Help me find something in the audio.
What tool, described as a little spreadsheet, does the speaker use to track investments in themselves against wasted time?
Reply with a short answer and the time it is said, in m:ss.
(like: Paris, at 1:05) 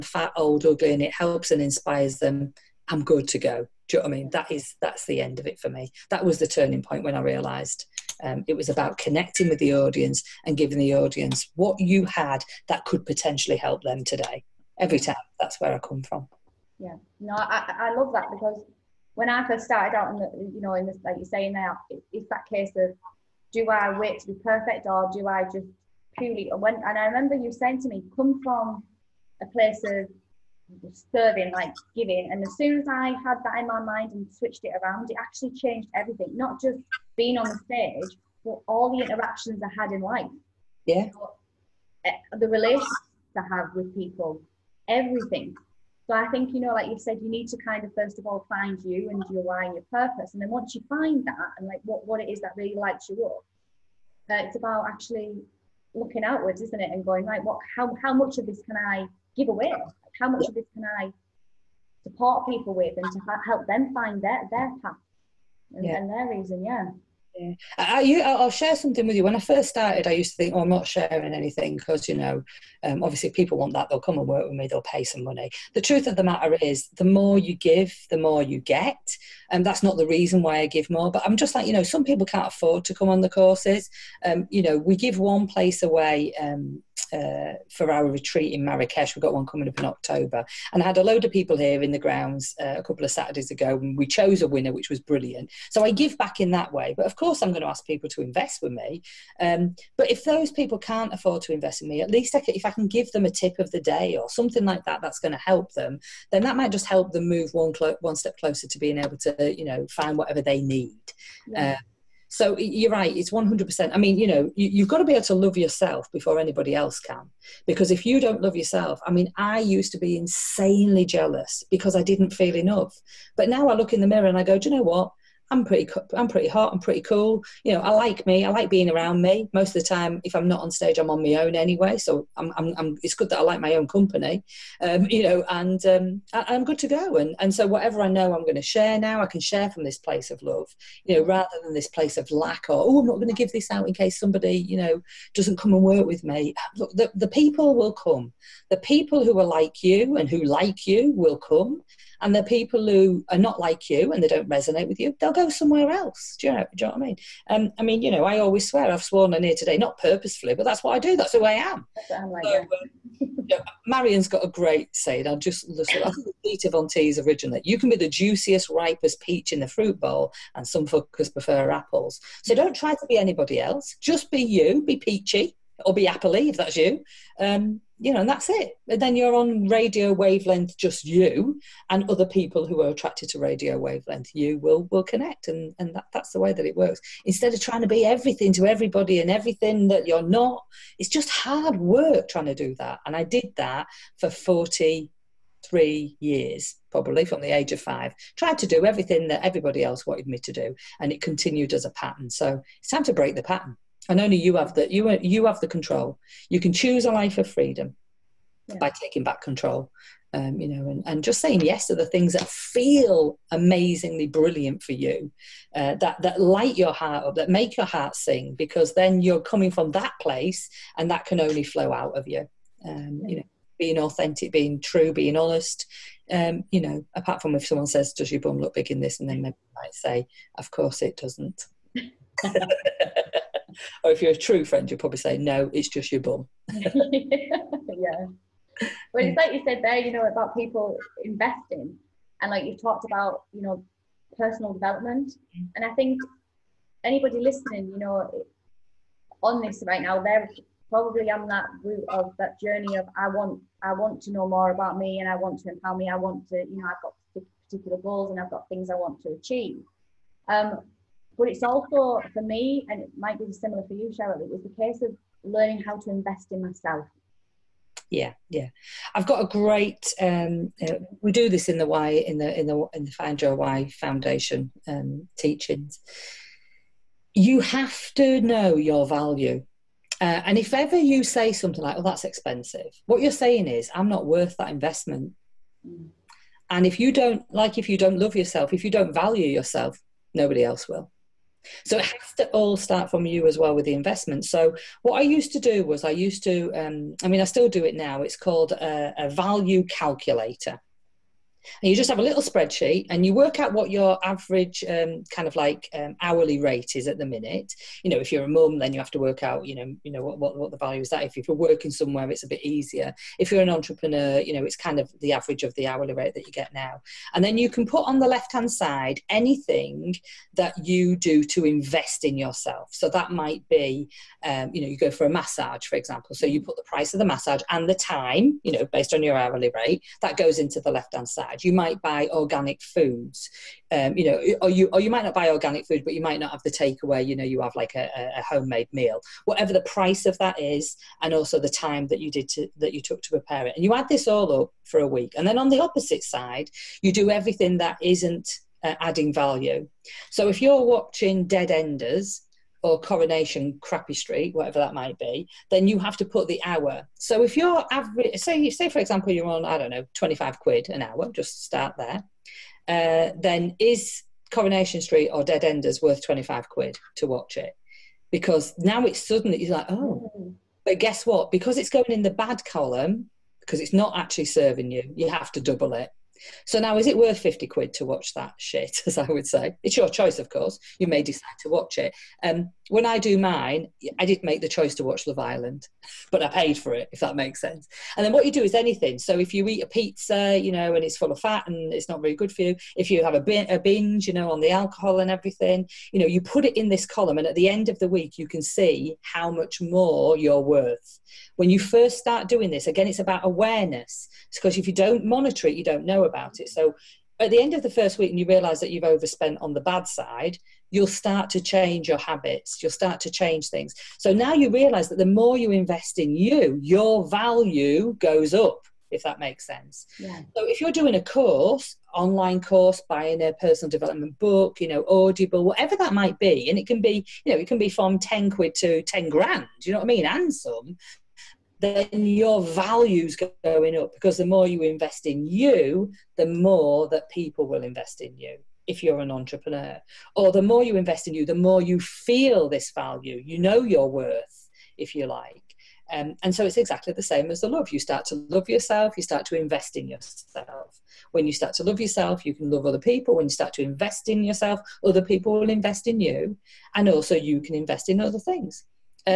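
Value calculator, at 4:59.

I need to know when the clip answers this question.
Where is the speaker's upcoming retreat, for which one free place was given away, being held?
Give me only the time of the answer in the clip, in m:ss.
1:28.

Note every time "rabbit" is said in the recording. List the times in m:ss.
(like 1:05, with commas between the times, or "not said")
not said.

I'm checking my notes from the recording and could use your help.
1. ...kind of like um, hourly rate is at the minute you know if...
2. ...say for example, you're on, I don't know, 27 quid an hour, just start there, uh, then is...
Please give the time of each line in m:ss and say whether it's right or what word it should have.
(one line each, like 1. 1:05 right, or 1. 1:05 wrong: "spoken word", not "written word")
1. 5:05 right
2. 5:58 wrong: "25", not "27".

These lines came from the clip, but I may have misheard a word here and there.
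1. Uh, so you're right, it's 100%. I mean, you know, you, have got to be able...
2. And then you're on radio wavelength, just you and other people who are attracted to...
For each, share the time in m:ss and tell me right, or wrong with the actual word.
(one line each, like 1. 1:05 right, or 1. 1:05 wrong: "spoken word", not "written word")
1. 1:51 right
2. 2:58 right.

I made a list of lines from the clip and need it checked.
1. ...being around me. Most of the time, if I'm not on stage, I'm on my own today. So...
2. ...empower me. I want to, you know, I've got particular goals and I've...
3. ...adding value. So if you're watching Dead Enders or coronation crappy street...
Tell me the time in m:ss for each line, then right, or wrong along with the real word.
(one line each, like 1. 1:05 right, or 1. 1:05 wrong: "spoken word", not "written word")
1. 2:08 wrong: "anyway", not "today"
2. 4:15 right
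3. 5:48 right.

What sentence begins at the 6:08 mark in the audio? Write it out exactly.
Because now it's suddenly, you're like, oh, but guess what?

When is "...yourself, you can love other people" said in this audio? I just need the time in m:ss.
7:31.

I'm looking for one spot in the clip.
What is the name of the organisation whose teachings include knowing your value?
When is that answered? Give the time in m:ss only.
4:33.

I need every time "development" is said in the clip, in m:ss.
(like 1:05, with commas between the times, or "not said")
4:04, 7:03.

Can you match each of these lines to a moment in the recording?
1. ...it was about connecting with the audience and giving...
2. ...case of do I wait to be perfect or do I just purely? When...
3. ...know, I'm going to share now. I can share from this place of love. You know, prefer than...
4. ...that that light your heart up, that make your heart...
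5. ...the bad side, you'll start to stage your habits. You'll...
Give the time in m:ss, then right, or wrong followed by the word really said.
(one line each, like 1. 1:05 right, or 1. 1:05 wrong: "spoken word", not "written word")
1. 0:08 right
2. 0:22 right
3. 2:18 wrong: "rather", not "prefer"
4. 3:35 right
5. 6:49 wrong: "change", not "stage".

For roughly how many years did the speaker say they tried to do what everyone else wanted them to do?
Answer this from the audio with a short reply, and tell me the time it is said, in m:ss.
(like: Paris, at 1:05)
43, at 3:14.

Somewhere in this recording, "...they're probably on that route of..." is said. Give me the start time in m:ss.
4:10.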